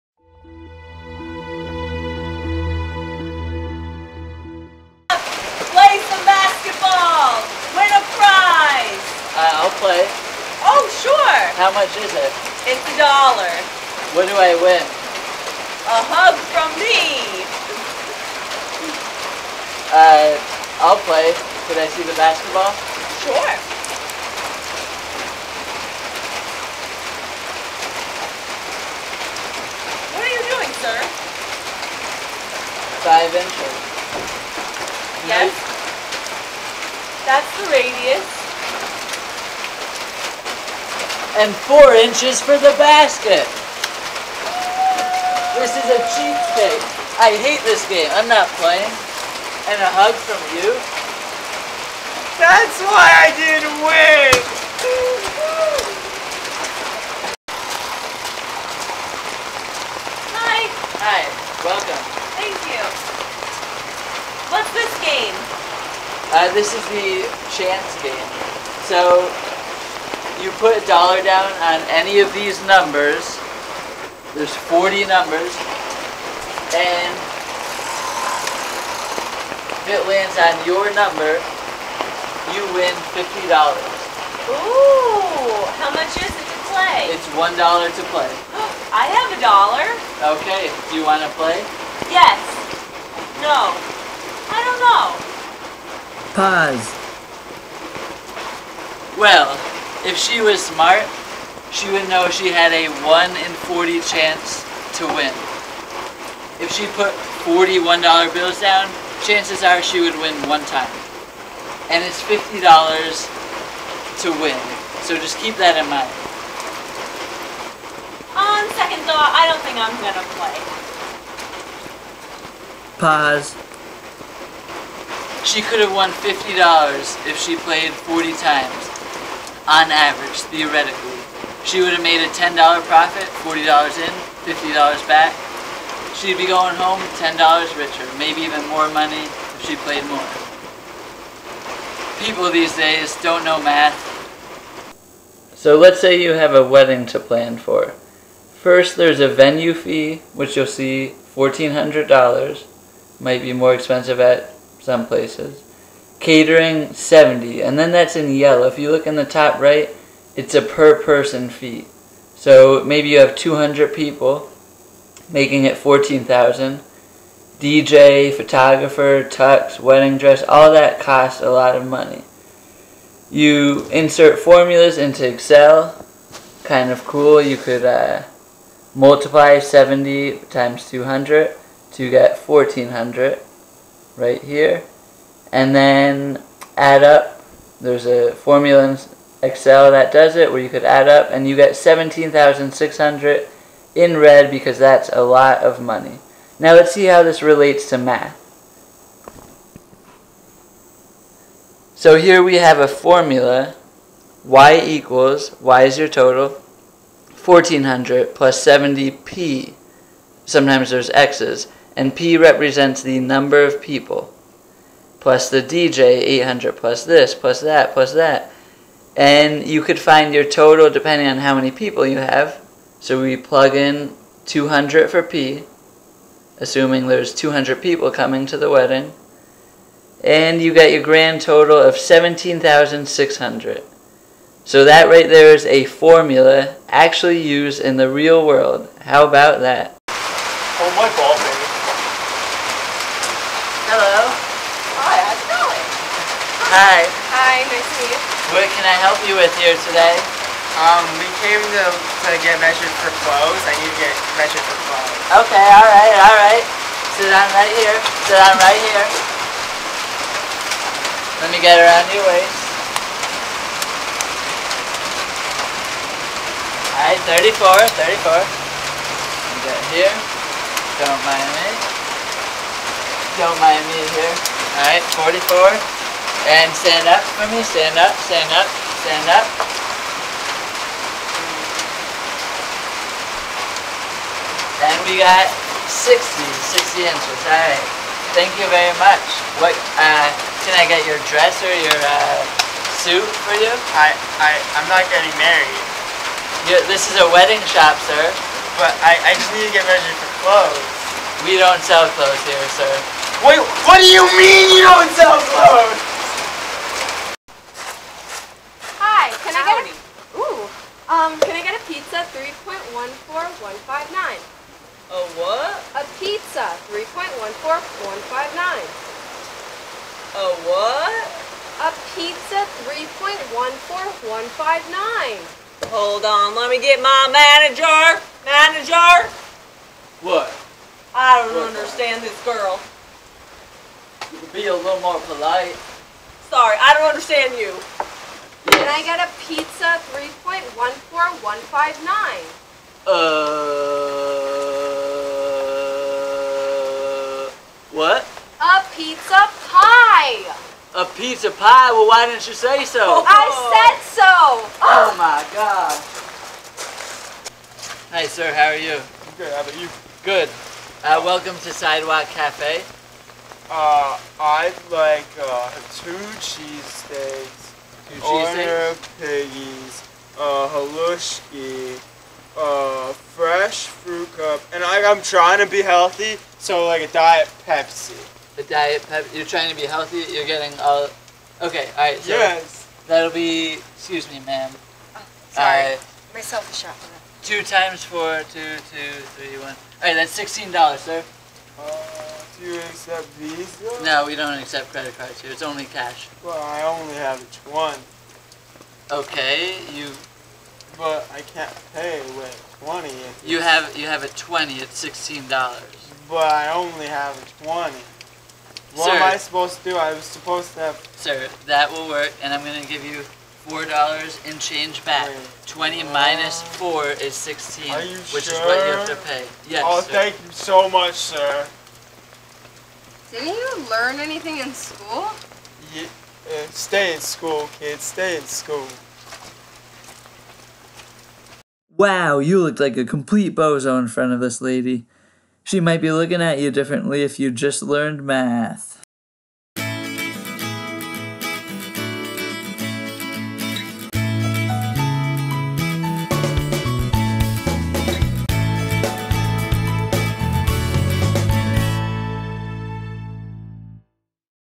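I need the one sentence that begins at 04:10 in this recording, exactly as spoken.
Um, we came to, to get measured for clothes.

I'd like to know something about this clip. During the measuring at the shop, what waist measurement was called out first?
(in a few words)
34.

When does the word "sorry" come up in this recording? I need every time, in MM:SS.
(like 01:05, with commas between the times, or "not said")
05:36, 06:25.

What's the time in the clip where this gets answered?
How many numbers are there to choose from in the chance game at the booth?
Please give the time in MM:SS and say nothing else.
01:14.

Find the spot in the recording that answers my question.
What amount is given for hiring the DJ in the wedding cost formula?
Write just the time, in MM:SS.
03:35.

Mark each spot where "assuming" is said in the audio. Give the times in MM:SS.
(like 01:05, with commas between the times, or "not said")
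03:46.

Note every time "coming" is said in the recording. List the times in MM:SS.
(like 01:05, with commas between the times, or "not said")
03:48.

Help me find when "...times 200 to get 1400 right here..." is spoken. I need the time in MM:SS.
03:00.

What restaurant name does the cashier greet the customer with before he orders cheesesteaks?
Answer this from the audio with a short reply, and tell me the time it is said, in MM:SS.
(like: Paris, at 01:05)
Sidewalk Cafe, at 06:01.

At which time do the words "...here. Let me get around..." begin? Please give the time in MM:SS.
04:18.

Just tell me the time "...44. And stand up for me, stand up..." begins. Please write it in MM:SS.
04:35.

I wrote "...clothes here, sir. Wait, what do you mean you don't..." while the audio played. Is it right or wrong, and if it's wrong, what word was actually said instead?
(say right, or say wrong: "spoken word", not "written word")
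right.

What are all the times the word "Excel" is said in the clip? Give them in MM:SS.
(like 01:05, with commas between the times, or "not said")
02:55, 03:09.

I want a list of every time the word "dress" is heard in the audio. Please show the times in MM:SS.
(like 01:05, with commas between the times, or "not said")
02:50, 04:51.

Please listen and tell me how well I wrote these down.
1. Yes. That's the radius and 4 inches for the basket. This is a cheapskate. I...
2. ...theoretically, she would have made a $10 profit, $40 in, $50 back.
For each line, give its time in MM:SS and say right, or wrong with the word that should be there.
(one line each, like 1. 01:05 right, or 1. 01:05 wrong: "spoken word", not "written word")
1. 00:35 right
2. 02:10 right.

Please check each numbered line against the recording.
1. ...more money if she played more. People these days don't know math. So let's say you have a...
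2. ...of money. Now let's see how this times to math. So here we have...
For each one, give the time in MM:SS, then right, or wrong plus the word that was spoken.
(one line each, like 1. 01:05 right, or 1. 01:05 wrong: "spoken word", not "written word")
1. 02:18 right
2. 03:15 wrong: "relates", not "times".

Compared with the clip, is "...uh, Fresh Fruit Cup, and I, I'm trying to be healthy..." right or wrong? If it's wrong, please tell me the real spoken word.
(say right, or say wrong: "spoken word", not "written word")
right.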